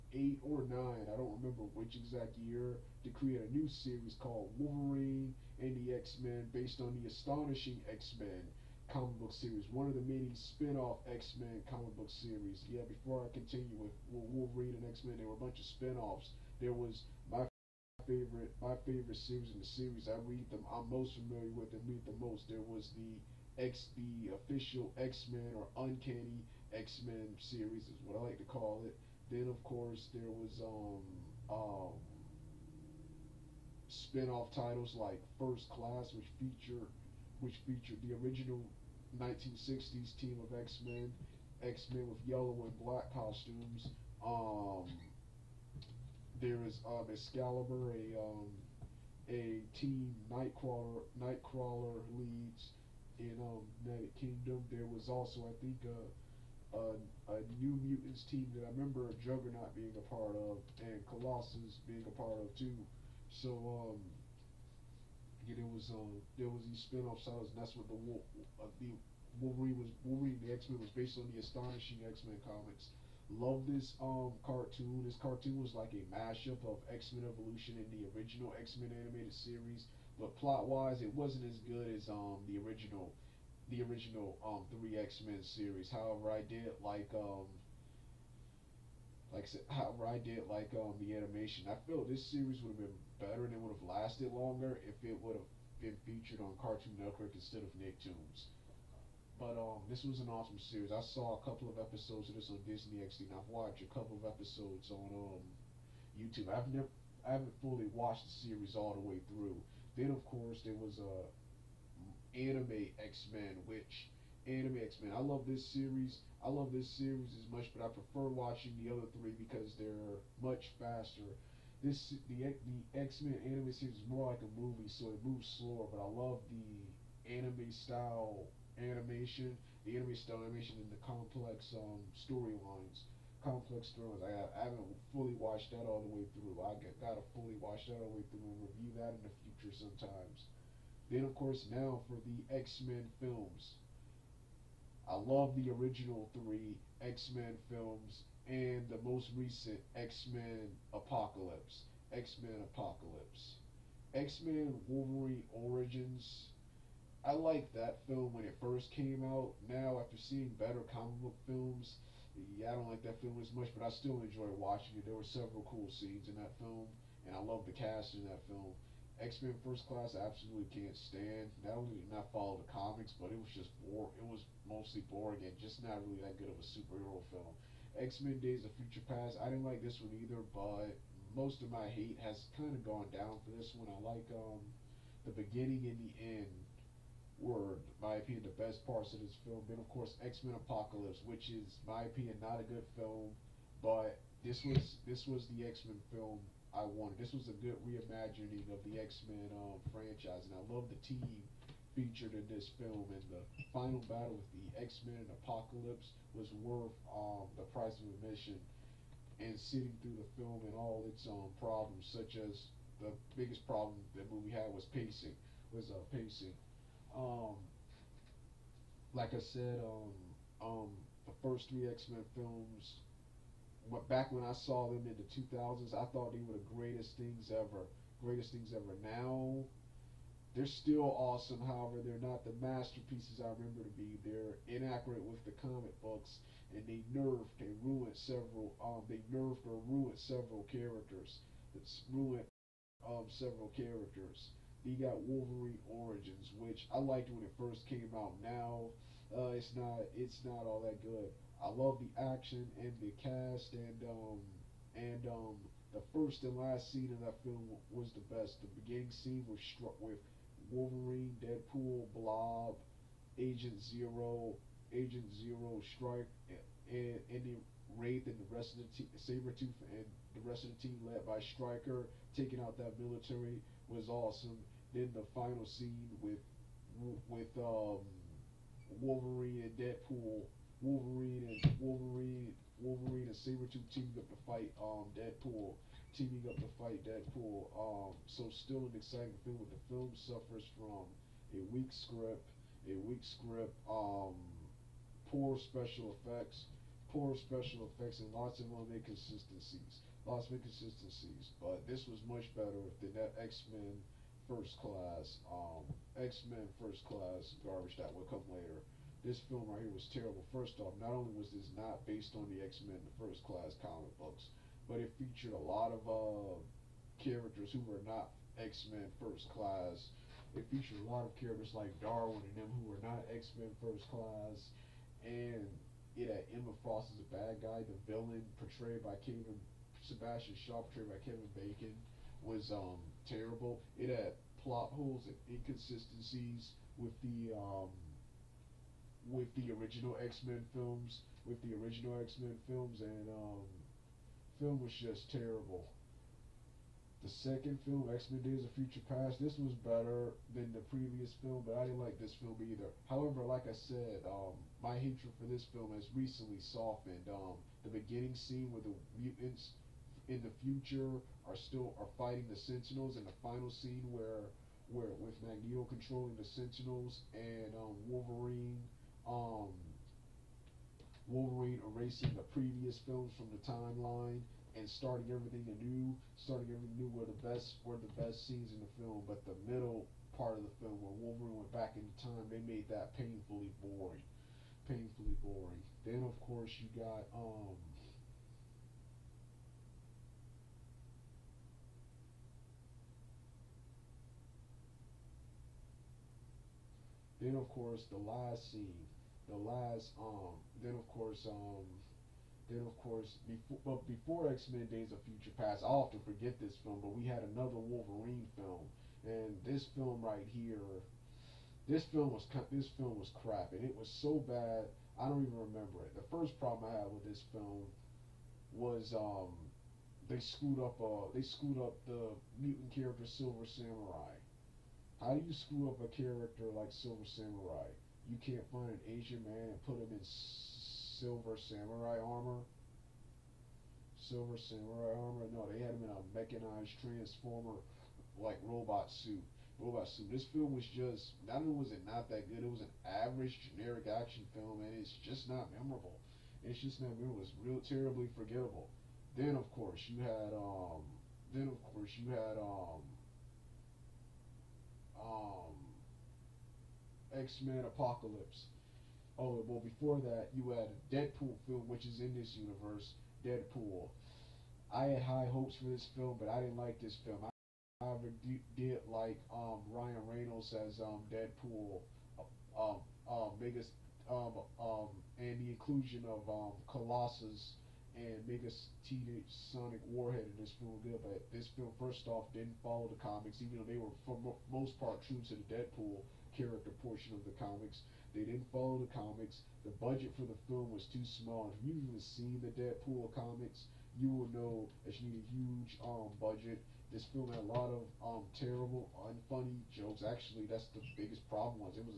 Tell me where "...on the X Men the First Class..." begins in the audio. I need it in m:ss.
5:12.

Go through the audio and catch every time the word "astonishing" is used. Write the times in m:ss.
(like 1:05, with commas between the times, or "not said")
0:07, 1:11.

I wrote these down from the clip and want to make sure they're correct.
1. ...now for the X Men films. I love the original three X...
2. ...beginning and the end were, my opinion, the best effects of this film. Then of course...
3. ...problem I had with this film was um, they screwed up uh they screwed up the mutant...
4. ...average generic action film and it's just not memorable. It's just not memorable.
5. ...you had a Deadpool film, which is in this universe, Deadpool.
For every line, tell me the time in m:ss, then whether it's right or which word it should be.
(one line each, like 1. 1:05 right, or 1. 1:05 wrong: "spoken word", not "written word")
1. 2:21 right
2. 3:05 wrong: "parts", not "effects"
3. 6:56 right
4. 7:23 right
5. 7:40 right.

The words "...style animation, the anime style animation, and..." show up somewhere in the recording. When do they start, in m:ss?
2:07.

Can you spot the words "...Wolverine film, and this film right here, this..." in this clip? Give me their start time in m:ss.
6:47.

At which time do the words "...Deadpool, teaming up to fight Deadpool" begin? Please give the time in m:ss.
4:45.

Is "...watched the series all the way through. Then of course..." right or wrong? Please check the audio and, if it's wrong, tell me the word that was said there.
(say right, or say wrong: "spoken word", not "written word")
right.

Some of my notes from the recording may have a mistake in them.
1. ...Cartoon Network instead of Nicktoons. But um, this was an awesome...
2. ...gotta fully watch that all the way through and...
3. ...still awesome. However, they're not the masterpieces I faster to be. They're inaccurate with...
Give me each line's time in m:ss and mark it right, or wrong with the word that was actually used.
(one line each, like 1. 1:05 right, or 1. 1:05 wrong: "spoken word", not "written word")
1. 1:36 right
2. 2:16 right
3. 3:50 wrong: "remember", not "faster".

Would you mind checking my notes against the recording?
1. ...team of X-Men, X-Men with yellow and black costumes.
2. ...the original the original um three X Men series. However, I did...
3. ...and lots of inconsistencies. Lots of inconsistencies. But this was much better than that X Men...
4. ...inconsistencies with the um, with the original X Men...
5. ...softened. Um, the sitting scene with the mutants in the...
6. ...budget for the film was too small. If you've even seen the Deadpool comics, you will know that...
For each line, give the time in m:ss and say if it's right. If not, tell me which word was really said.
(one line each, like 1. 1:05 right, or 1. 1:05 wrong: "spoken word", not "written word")
1. 0:40 right
2. 1:22 right
3. 4:58 right
4. 5:35 right
5. 5:56 wrong: "beginning", not "sitting"
6. 8:10 right.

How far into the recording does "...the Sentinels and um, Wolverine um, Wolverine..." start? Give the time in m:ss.
6:06.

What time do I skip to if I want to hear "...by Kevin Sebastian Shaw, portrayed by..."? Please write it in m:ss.
5:29.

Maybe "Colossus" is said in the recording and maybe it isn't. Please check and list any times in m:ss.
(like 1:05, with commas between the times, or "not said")
1:01, 7:56.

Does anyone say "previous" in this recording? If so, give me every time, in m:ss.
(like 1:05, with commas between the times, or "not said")
5:50, 6:12.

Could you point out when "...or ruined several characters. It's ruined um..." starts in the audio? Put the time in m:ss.
3:59.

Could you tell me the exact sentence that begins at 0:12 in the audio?
Yeah, before I continue with, Wolverine and X Men, there were a bunch of spin offs.